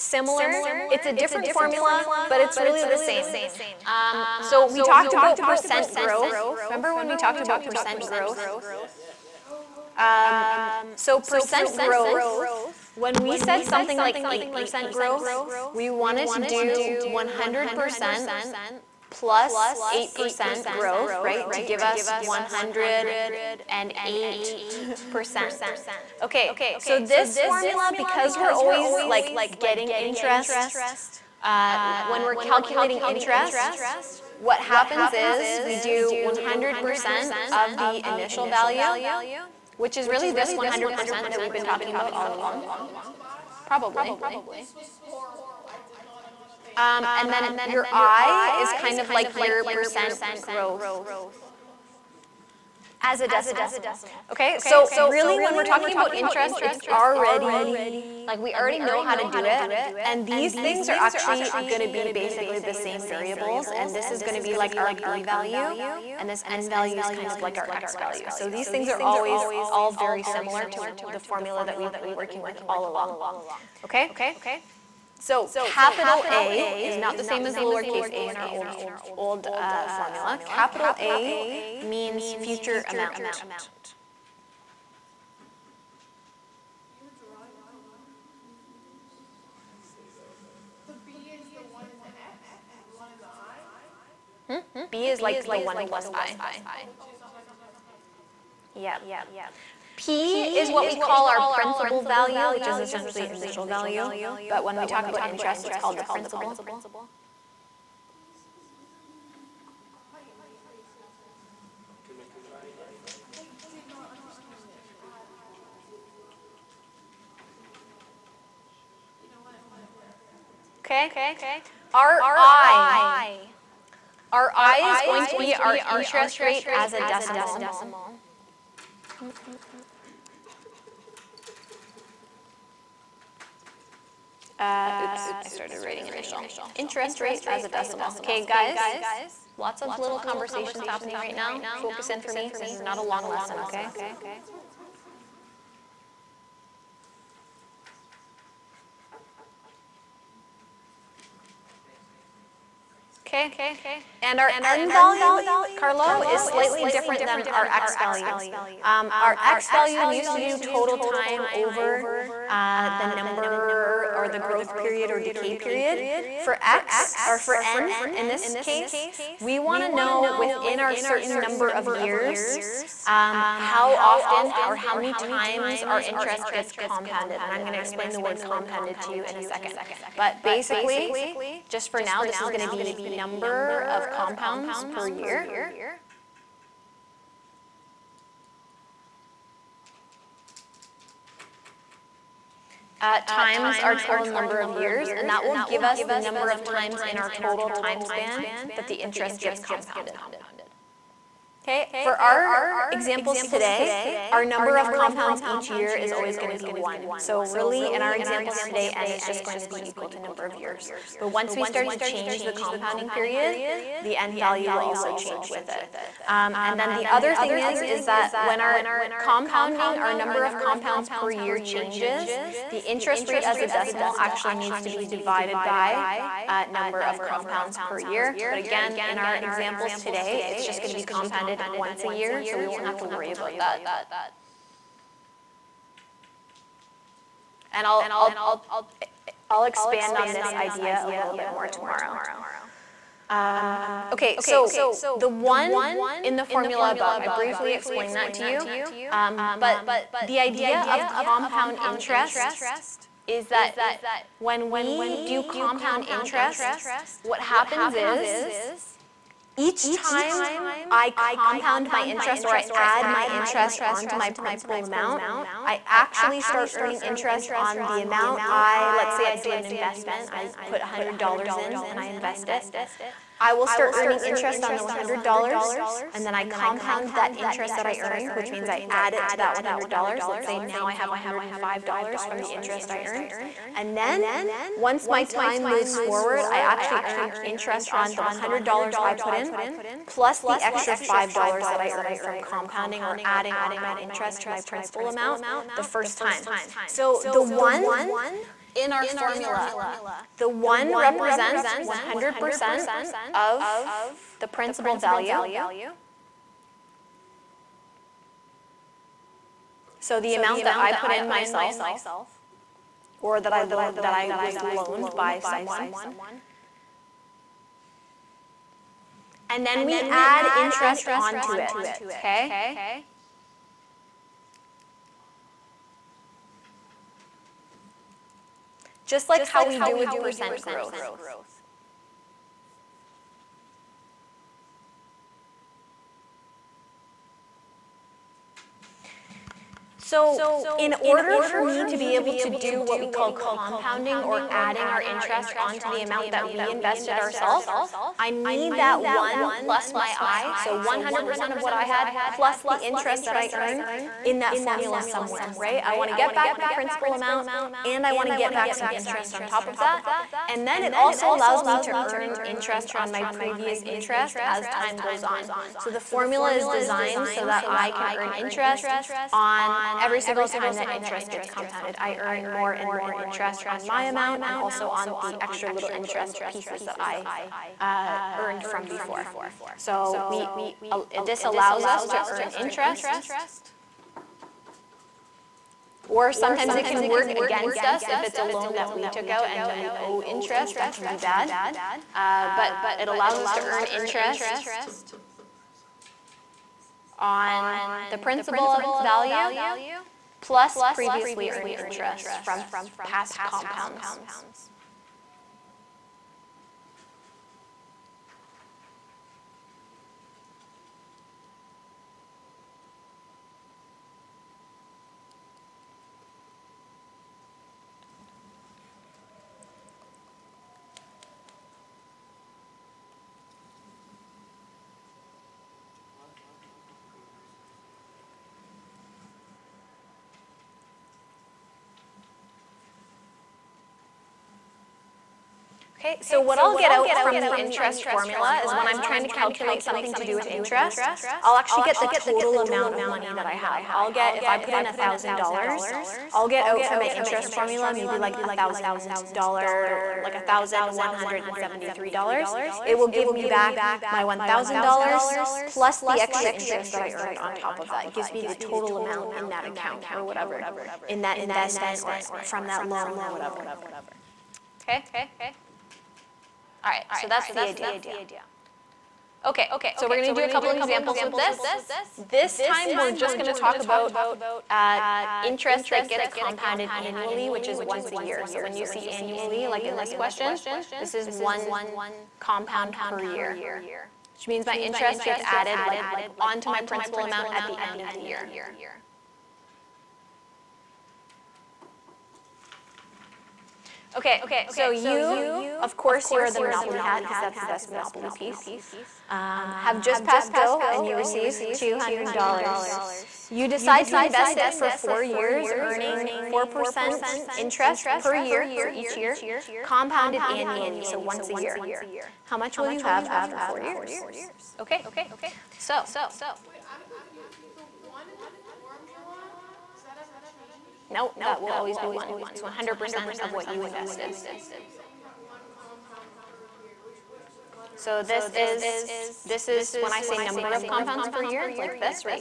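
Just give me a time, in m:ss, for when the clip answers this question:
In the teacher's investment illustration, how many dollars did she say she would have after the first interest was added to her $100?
4:41.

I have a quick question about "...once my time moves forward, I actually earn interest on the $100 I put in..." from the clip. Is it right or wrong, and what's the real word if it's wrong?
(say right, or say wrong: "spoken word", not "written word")
right.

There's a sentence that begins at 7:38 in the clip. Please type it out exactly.
It gives me the total amount in that account or whatever, in that investment or from that loan or whatever.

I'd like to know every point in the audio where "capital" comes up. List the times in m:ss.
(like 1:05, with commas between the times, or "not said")
1:15, 1:20.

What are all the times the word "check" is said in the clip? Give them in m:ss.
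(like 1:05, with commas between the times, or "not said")
not said.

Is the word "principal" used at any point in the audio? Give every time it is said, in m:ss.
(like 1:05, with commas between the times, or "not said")
1:41, 1:46, 4:24, 4:54, 5:04, 5:56, 6:38, 8:06.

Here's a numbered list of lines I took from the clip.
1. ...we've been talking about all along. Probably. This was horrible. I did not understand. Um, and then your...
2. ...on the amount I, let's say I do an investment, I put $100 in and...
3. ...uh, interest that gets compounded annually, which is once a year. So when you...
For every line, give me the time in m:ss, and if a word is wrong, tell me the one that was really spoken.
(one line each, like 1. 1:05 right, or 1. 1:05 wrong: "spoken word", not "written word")
1. 0:41 right
2. 4:27 right
3. 7:54 right.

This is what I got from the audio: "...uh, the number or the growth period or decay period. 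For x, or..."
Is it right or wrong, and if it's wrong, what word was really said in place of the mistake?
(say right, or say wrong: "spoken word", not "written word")
right.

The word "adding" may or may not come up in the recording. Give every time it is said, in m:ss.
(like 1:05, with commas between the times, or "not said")
4:53, 5:44.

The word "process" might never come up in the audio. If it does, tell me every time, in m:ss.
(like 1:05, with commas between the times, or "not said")
not said.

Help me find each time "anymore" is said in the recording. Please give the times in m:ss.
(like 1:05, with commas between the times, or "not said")
not said.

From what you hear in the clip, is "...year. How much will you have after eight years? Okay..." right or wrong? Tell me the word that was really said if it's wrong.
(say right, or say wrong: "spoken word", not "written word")
wrong: "four", not "eight".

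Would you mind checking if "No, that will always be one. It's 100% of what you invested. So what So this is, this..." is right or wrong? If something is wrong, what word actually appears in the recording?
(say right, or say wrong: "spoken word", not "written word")
right.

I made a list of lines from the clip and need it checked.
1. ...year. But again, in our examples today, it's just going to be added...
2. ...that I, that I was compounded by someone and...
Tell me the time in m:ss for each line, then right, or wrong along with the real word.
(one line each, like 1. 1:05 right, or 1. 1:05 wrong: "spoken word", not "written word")
1. 3:48 wrong: "compounded", not "added"
2. 5:13 wrong: "loaned", not "compounded".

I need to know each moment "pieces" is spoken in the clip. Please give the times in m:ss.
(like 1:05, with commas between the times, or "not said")
6:16, 8:18.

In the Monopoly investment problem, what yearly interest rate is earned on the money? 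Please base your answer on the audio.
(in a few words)
4%.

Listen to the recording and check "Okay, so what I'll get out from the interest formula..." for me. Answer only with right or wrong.
right.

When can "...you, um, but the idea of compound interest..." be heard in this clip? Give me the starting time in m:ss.
4:08.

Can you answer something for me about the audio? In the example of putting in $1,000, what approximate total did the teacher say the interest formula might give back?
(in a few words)
$1,173.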